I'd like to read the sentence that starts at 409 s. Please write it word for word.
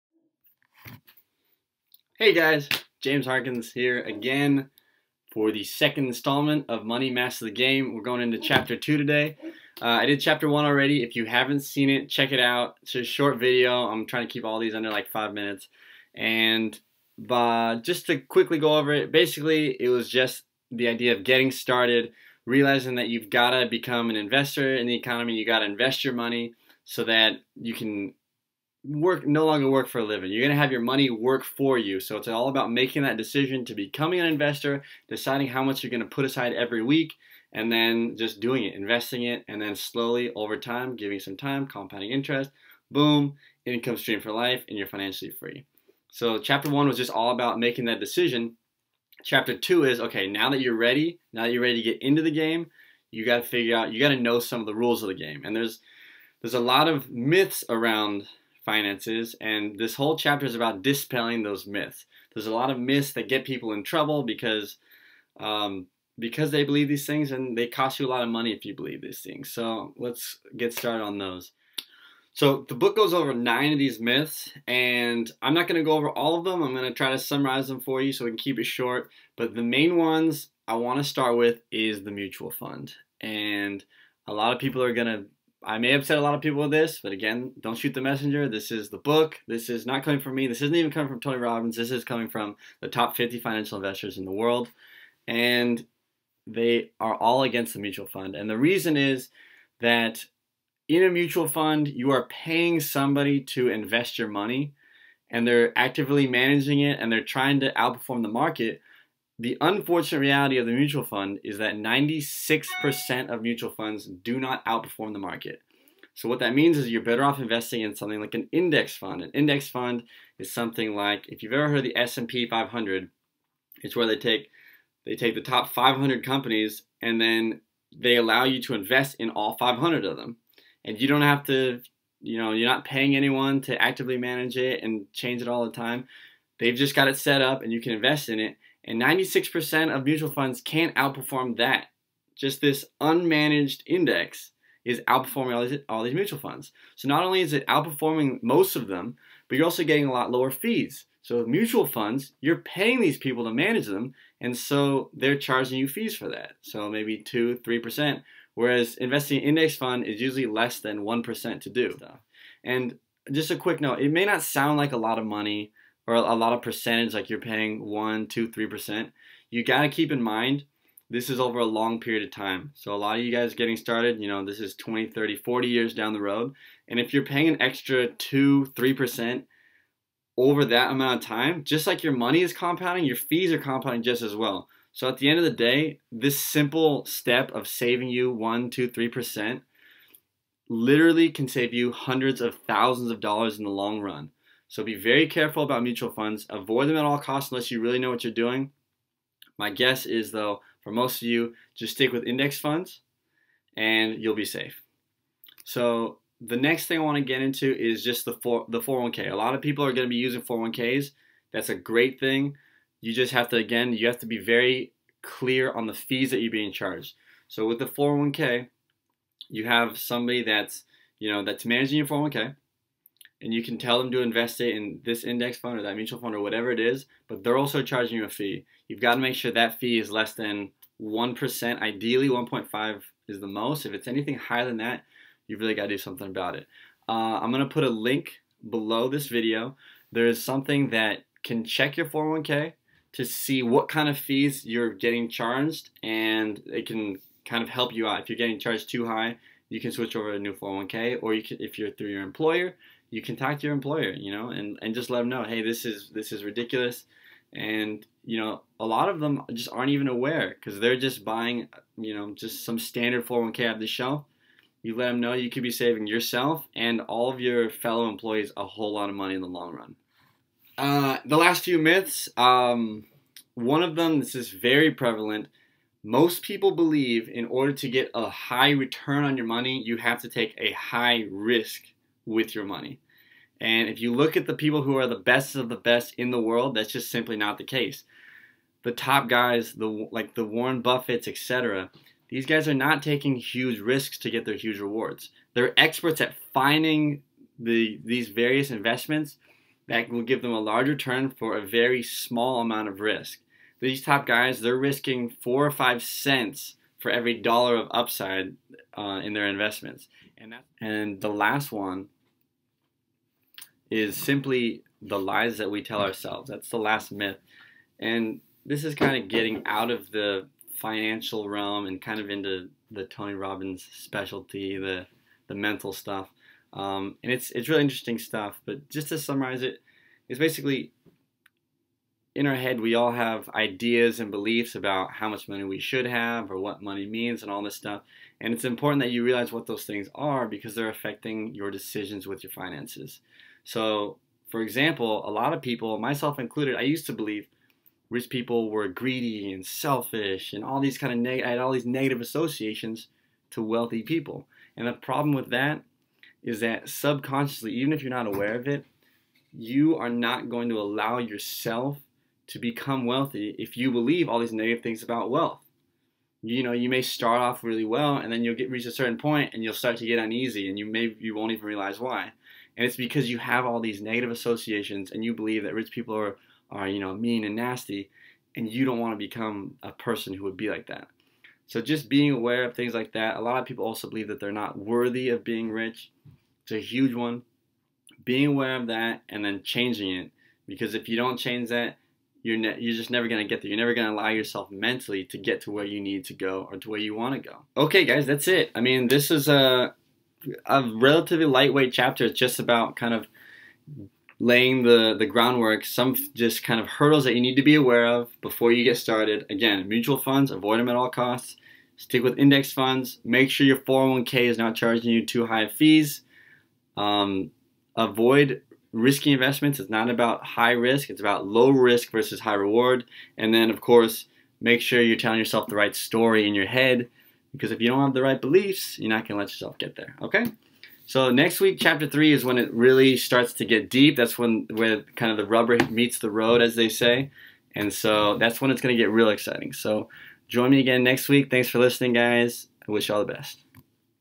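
Again, mutual funds, avoid them at all costs.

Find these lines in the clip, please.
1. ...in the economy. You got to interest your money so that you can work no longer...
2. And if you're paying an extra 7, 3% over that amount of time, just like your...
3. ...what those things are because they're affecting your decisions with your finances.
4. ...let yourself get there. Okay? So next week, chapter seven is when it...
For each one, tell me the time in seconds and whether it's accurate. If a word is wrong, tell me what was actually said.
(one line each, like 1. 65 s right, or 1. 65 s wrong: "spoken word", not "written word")
1. 24 s wrong: "invest", not "interest"
2. 176 s wrong: "2", not "7"
3. 339 s right
4. 429 s wrong: "three", not "seven".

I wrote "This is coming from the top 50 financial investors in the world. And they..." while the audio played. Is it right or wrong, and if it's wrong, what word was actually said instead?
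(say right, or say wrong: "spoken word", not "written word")
right.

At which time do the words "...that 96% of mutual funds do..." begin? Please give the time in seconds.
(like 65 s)
111 s.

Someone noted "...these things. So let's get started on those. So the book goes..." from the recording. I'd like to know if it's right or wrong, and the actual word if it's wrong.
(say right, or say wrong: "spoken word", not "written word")
right.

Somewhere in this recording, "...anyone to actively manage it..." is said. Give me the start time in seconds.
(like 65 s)
133 s.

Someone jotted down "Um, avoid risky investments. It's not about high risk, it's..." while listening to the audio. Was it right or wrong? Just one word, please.
right.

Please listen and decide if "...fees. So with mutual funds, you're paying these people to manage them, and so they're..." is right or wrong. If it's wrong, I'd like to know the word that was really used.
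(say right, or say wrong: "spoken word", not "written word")
right.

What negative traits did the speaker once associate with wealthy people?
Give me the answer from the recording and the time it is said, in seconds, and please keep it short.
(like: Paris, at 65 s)
greedy and selfish, at 348 s.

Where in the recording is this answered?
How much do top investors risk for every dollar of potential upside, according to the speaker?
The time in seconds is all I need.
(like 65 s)
305 s.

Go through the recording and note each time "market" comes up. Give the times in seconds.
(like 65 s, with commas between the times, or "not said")
108 s, 115 s.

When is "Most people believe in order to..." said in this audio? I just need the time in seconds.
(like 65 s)
276 s.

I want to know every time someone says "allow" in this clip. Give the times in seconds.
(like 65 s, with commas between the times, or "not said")
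128 s, 360 s, 394 s.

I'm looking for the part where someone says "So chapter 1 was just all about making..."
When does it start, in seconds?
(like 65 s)
46 s.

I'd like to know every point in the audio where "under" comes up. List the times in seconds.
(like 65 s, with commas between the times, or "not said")
14 s.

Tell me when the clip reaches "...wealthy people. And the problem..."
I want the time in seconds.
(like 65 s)
353 s.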